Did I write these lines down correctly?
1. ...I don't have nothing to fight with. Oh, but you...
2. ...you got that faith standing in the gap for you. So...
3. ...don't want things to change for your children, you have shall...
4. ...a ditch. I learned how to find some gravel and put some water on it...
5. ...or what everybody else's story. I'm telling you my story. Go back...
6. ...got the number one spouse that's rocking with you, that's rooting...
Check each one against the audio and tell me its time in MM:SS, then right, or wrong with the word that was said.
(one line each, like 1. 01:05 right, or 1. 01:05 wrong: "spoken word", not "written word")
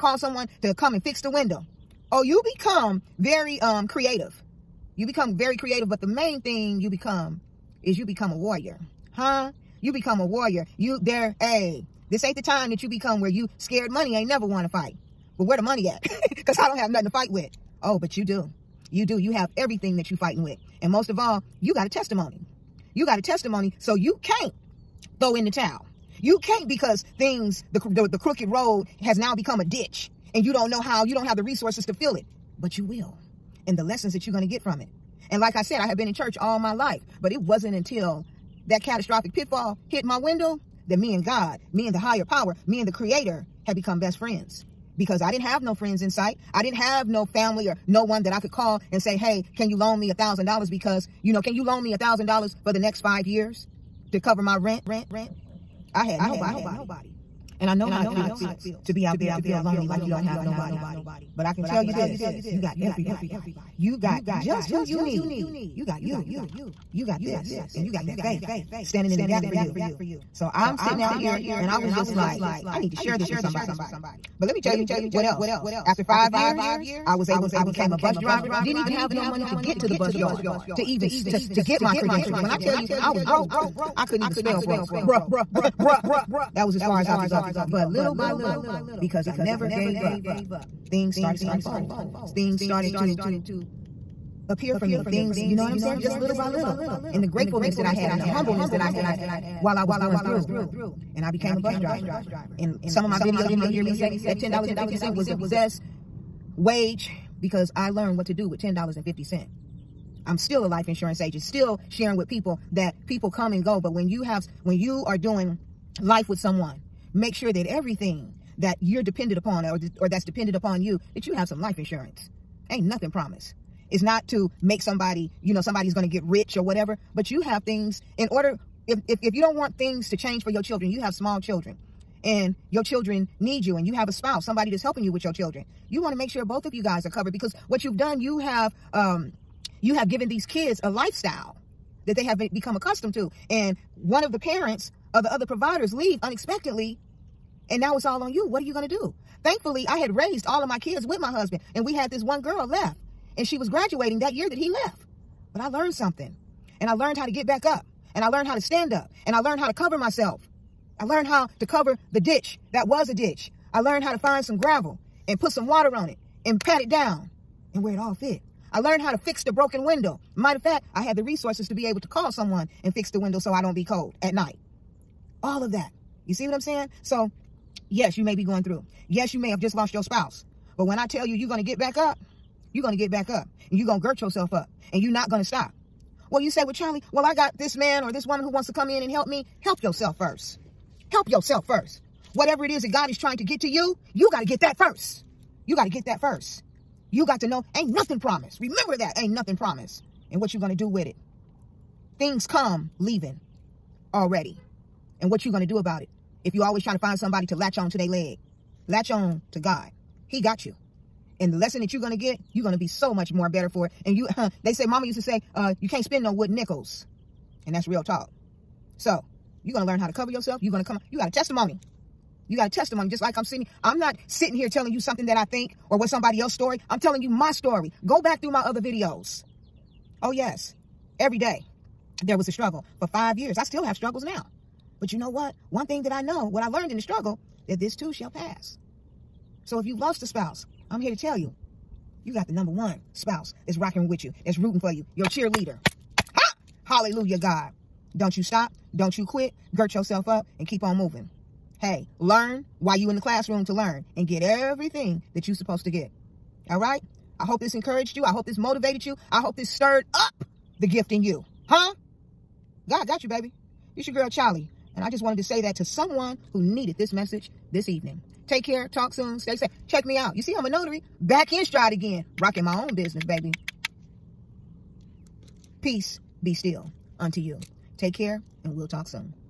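1. 00:16 right
2. 01:07 right
3. 02:09 wrong: "small", not "shall"
4. 02:43 right
5. 03:45 wrong: "somebody", not "everybody"
6. 04:02 right.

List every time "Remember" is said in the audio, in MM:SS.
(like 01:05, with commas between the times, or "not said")
03:18.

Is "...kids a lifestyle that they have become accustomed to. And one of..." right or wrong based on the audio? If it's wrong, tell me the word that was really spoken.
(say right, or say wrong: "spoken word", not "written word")
right.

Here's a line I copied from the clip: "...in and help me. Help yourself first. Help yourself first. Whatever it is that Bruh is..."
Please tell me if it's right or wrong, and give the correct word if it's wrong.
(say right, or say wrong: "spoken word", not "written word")
wrong: "God", not "Bruh".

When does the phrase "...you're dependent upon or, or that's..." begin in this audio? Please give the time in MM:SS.
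01:58.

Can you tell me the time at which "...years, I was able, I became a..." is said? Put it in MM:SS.
01:16.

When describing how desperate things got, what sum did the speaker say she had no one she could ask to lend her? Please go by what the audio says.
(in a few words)
$1,000.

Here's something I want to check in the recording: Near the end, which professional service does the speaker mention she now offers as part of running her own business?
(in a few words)
Notary.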